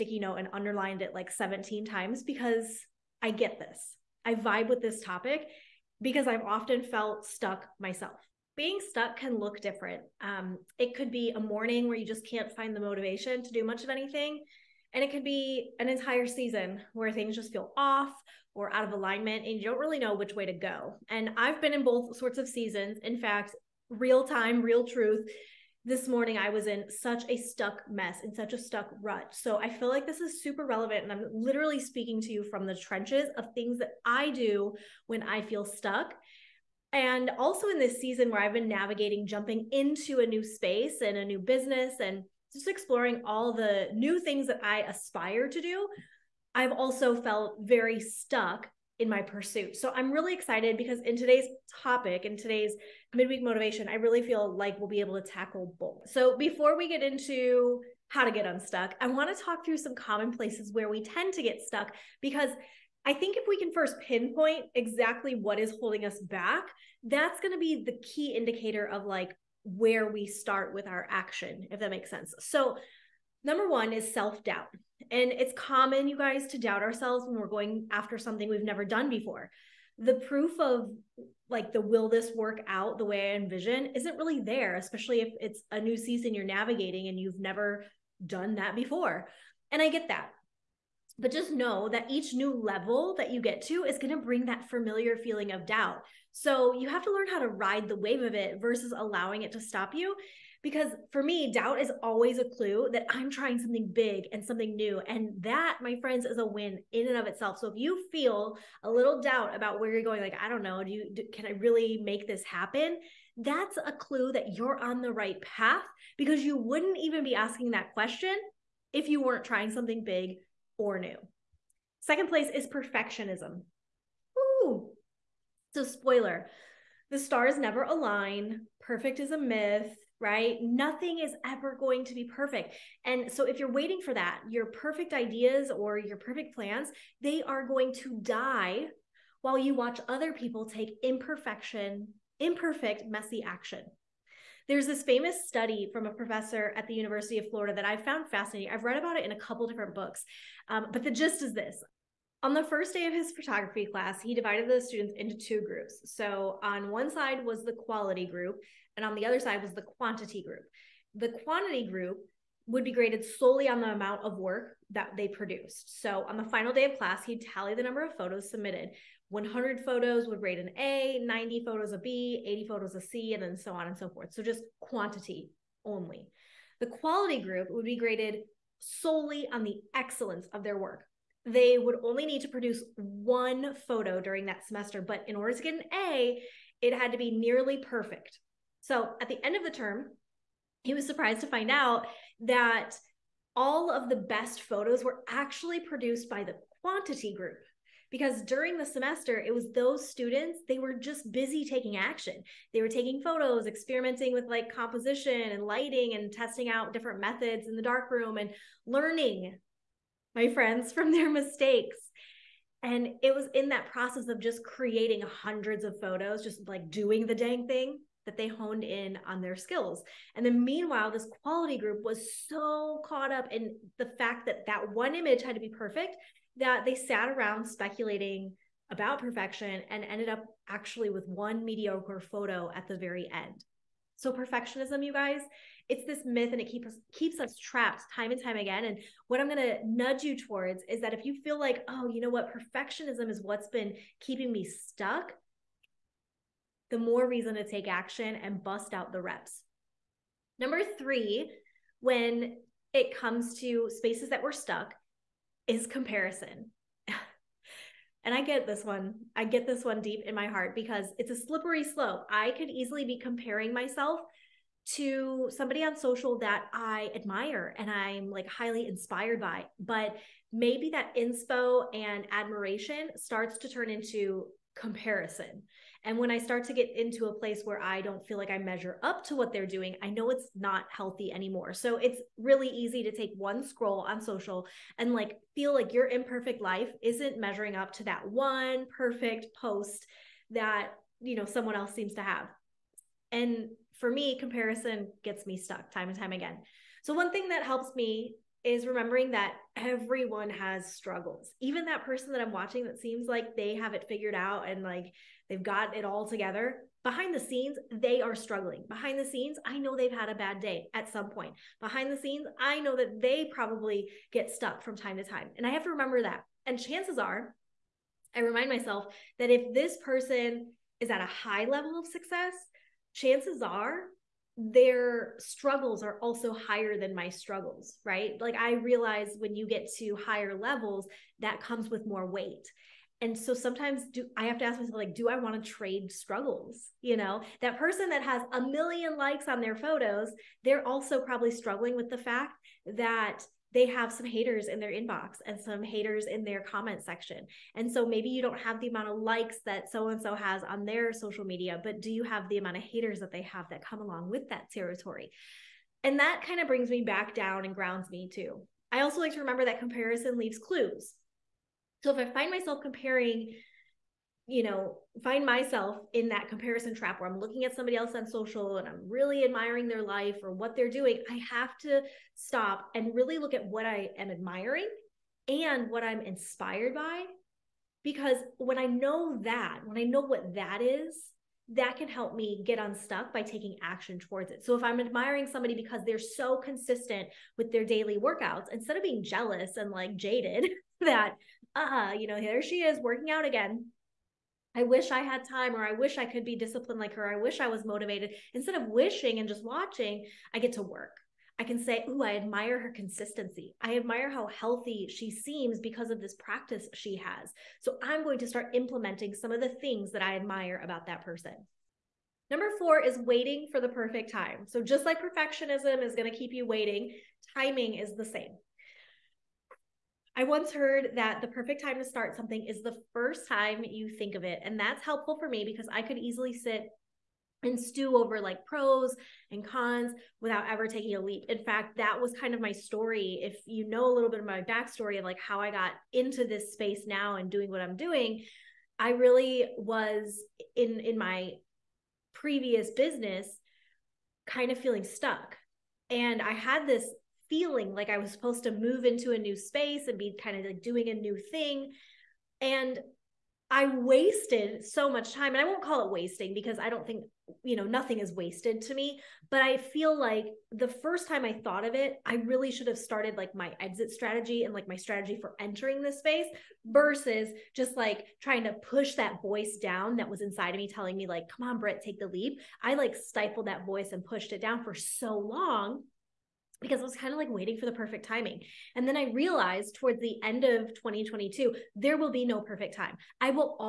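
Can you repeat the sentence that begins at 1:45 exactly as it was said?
And that, my friends, is a win in and of itself.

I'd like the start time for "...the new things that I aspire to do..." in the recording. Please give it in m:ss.
0:43.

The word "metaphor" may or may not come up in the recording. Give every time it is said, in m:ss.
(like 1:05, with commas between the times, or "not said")
not said.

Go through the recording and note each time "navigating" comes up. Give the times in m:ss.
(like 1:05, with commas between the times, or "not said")
0:38, 1:26.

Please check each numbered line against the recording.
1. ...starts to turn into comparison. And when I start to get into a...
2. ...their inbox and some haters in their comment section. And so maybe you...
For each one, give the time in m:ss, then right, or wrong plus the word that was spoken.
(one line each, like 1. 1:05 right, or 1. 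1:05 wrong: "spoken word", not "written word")
1. 4:33 right
2. 5:44 right.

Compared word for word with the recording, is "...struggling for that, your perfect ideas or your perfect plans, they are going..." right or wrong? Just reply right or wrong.
wrong.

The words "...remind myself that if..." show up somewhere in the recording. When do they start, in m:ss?
5:18.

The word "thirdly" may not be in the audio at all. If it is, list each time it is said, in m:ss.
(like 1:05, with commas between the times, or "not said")
not said.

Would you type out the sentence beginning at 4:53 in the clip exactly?
And for me, comparison gets me stuck time and time again.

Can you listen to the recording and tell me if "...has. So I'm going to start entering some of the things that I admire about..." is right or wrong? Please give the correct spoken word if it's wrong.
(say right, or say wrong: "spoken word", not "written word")
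wrong: "implementing", not "entering".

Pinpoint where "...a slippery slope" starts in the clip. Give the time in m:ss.
4:21.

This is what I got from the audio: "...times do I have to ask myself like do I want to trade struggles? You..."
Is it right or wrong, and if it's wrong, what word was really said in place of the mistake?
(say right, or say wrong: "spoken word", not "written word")
wrong: "sometimes", not "times".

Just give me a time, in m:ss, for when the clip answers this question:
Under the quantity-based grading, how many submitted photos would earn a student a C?
2:52.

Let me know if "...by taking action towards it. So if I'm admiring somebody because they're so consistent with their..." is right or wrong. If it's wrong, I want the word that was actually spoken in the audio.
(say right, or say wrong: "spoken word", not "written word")
right.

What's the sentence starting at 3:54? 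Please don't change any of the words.
So perfectionism, you guys, it's this myth and it keeps us keeps us trapped time and time again.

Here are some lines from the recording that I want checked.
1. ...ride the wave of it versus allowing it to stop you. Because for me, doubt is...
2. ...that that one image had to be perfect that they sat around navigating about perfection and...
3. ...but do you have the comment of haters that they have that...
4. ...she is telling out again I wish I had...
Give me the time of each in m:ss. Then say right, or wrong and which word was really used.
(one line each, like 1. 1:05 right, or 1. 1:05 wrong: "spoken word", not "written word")
1. 1:37 right
2. 3:44 wrong: "speculating", not "navigating"
3. 5:51 wrong: "amount", not "comment"
4. 6:32 wrong: "working", not "telling".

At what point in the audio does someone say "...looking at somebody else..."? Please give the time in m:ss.
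6:07.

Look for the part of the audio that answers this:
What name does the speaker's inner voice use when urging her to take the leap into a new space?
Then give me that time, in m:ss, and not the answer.
7:51.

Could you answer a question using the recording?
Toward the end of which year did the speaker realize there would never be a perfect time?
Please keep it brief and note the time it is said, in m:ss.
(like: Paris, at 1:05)
2022, at 8:00.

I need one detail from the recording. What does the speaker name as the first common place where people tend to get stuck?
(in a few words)
self doubt.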